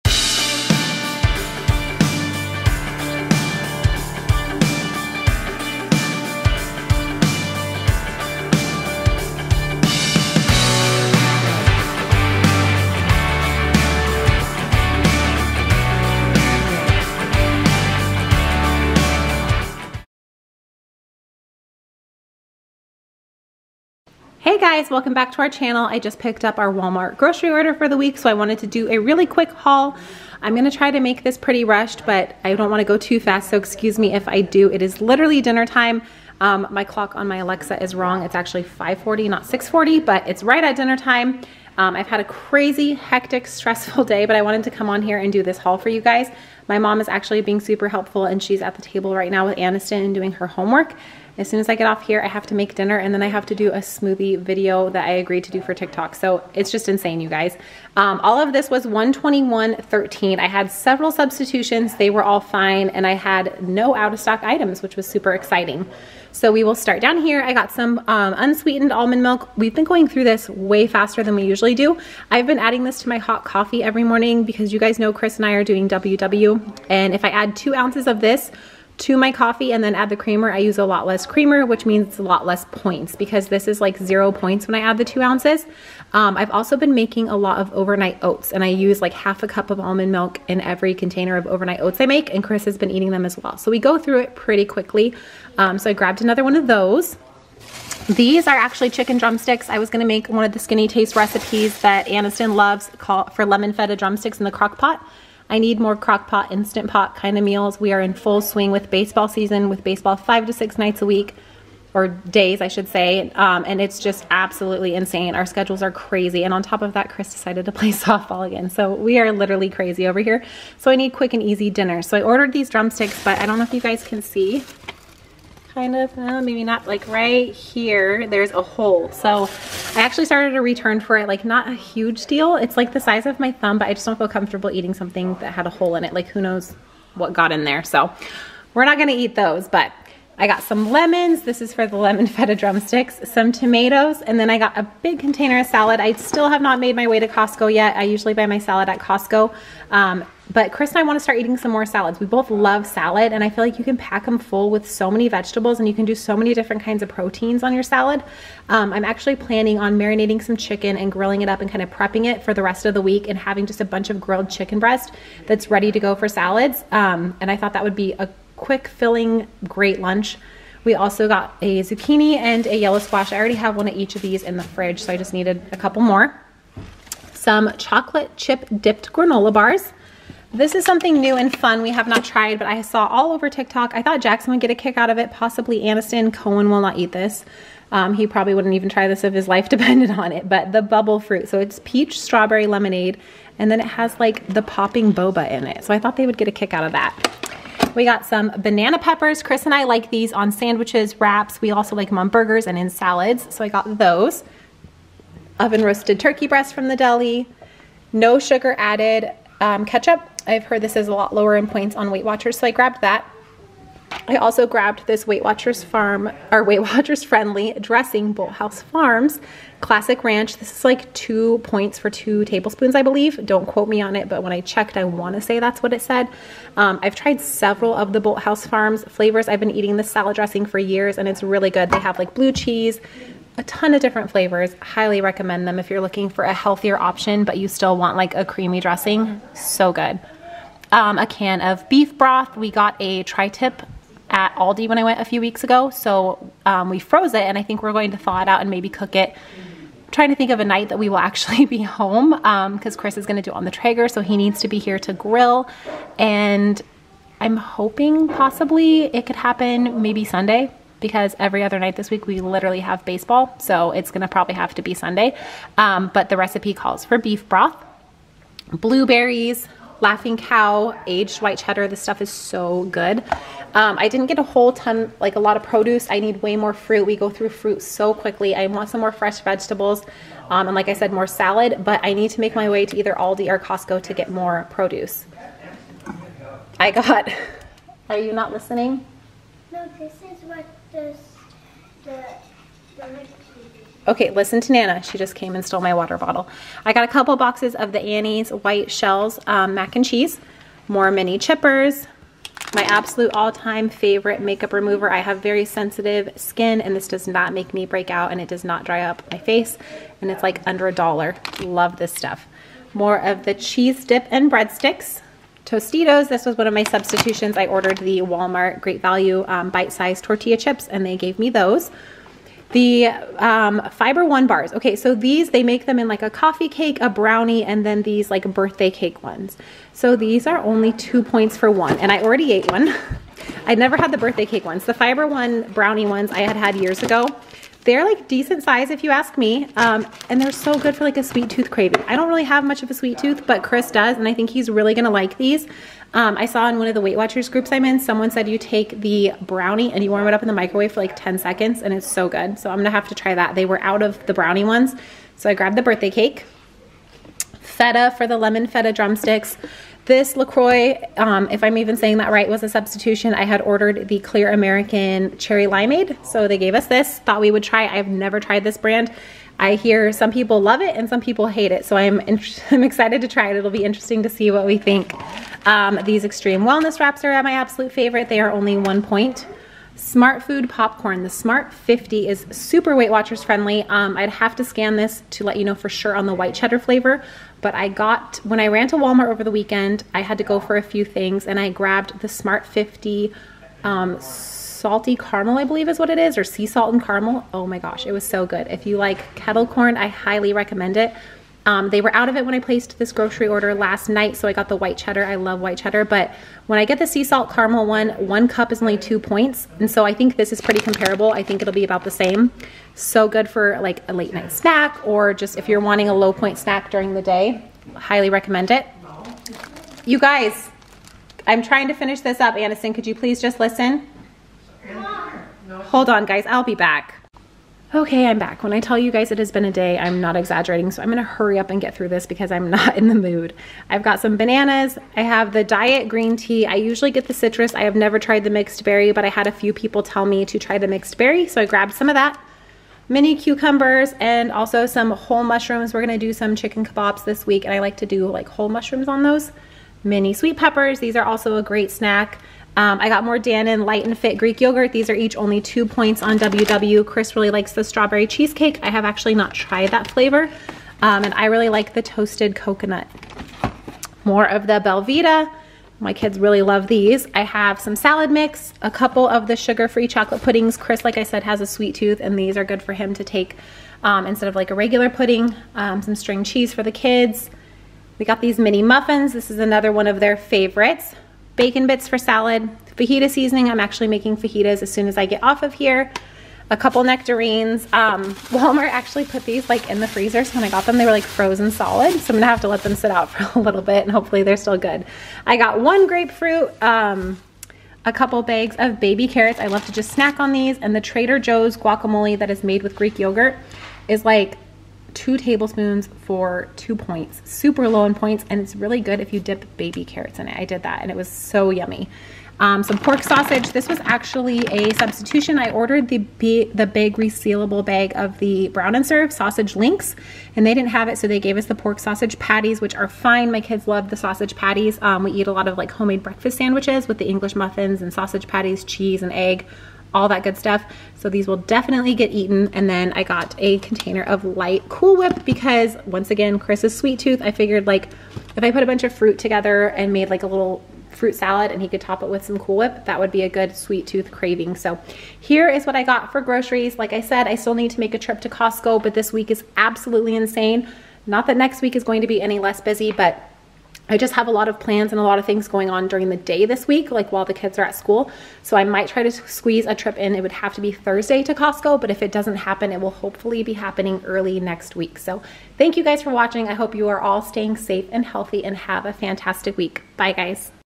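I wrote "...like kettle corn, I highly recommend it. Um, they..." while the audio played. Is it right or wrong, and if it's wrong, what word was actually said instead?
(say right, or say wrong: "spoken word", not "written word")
right.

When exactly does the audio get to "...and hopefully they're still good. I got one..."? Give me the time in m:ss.
8:14.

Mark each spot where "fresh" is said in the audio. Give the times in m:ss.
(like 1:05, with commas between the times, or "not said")
4:39.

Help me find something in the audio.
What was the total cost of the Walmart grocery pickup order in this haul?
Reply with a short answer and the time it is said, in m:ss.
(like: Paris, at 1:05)
$121.13, at 0:58.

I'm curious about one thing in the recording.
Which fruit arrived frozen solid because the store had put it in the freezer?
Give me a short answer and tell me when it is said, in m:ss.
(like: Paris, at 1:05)
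Nectarines, at 8:07.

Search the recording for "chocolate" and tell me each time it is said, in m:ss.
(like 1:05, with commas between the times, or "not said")
2:57, 7:50.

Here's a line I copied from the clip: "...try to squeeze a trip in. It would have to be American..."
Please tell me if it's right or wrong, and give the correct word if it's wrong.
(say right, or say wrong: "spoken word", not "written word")
wrong: "Thursday", not "American".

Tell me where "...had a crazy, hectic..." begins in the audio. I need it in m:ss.
0:42.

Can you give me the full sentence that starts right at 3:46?
Um, I've tried several of the House Farms flavors.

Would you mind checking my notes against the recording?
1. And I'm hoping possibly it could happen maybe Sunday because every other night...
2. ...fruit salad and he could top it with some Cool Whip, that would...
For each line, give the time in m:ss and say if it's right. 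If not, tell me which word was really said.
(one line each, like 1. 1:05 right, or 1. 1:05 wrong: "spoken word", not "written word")
1. 4:16 right
2. 9:01 right.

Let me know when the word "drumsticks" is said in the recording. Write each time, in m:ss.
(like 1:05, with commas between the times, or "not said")
1:39, 1:43, 2:02, 2:22, 5:58.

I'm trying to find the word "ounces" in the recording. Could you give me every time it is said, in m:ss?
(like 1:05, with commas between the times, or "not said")
1:17, 1:25.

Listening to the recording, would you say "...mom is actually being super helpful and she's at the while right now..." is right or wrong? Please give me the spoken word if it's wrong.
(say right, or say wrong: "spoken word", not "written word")
wrong: "table", not "while".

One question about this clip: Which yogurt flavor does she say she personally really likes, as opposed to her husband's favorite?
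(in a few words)
Toasted coconut.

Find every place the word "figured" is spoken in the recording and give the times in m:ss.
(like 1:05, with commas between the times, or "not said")
8:57.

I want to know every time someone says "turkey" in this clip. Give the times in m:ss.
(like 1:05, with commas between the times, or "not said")
3:26.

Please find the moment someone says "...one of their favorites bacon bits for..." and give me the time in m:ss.
7:59.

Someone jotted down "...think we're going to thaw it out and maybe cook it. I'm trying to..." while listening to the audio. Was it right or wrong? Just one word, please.
right.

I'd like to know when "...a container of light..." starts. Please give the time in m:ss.
8:53.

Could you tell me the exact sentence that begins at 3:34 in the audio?
I also grabbed this Weight Watchers Farm, or Weight Watchers Friendly Dressing House Farms Classic Ranch.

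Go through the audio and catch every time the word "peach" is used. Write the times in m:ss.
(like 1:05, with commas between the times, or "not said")
3:11.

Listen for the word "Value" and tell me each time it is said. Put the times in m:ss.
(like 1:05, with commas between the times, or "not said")
5:19.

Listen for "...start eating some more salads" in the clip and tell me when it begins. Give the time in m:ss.
2:31.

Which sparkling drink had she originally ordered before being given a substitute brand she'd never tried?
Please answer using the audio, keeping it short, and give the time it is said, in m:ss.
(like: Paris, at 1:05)
Clear American Cherry Limeade, at 6:04.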